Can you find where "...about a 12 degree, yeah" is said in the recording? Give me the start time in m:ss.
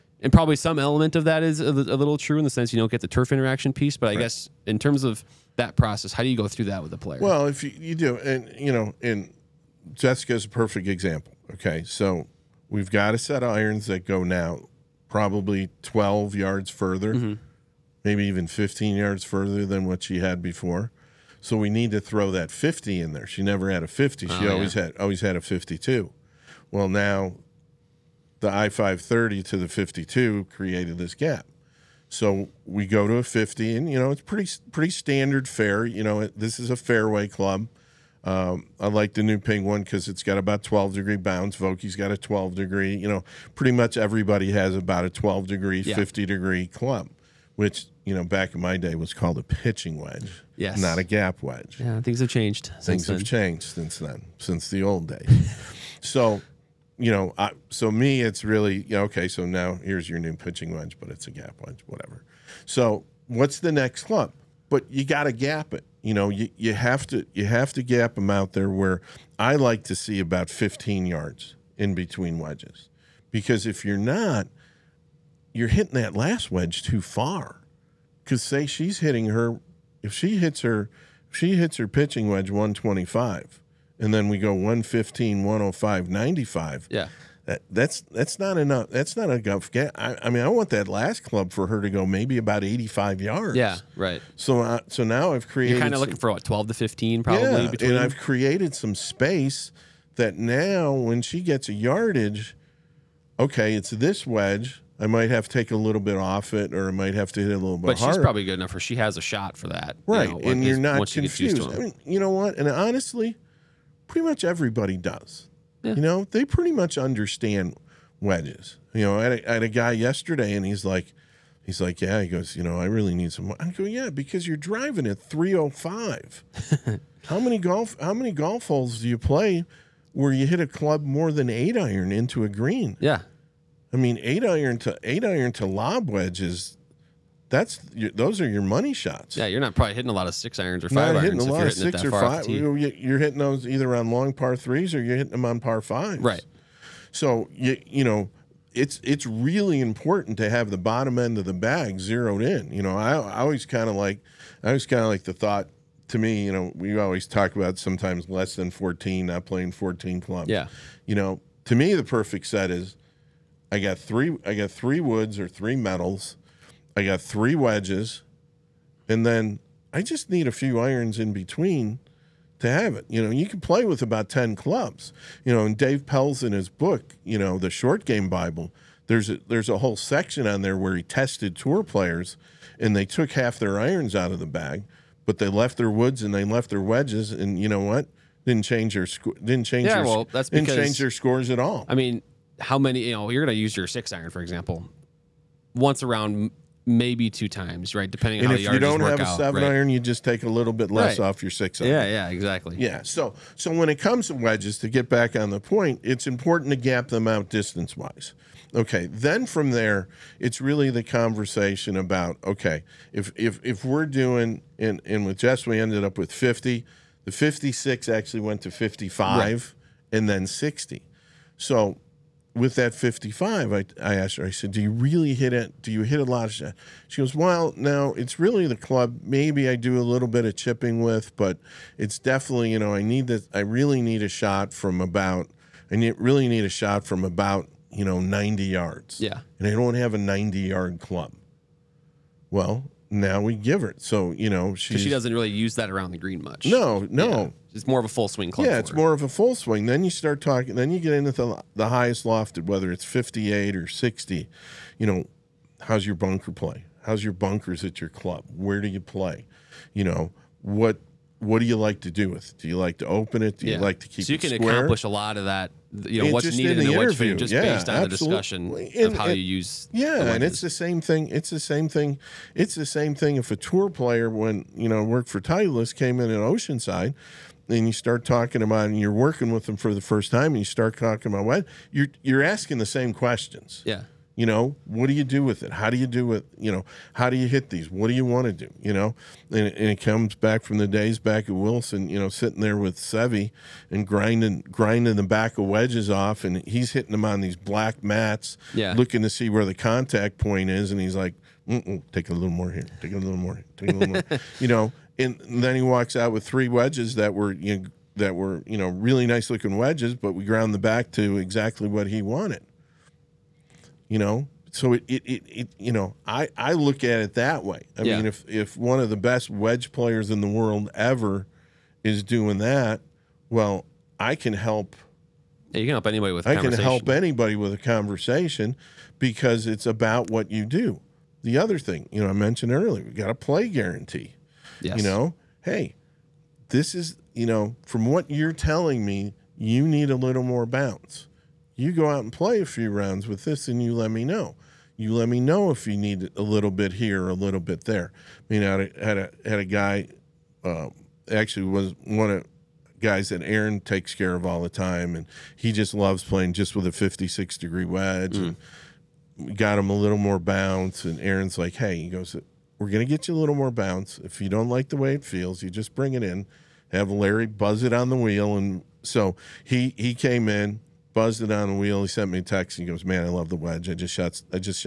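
0:44.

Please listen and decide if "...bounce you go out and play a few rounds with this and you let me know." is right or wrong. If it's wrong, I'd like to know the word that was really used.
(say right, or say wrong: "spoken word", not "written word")
right.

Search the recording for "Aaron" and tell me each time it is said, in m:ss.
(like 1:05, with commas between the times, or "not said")
5:53, 6:01.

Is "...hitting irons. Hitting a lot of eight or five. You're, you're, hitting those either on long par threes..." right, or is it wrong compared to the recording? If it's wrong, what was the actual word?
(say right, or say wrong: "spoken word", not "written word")
wrong: "six", not "eight".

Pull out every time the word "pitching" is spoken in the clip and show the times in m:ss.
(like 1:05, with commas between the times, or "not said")
0:49, 1:00, 1:21.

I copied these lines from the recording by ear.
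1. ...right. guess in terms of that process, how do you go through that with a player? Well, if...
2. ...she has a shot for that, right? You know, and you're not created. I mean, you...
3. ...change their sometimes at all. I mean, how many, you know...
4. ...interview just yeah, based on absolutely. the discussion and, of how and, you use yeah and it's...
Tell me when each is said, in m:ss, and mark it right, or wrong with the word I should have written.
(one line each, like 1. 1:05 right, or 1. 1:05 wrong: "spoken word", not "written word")
1. 0:04 right
2. 1:48 wrong: "confused", not "created"
3. 3:10 wrong: "scores", not "sometimes"
4. 4:26 right.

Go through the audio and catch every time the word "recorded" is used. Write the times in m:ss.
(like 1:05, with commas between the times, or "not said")
not said.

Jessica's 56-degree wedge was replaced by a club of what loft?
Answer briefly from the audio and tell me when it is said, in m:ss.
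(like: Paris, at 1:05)
55, at 3:38.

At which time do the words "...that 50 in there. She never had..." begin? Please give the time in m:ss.
0:22.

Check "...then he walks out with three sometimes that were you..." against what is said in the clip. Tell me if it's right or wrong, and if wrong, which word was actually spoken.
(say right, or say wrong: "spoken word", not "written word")
wrong: "wedges", not "sometimes".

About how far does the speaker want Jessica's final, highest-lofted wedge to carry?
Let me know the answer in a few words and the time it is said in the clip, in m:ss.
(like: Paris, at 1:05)
85 yards, at 1:32.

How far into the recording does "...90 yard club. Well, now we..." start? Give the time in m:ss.
4:00.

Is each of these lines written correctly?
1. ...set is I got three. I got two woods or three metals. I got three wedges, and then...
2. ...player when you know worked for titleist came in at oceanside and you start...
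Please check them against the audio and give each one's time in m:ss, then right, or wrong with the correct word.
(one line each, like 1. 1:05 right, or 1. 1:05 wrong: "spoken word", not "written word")
1. 2:42 wrong: "three", not "two"
2. 4:33 right.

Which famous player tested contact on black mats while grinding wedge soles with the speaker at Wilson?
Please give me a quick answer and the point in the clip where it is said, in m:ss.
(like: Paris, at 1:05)
Seve, at 4:52.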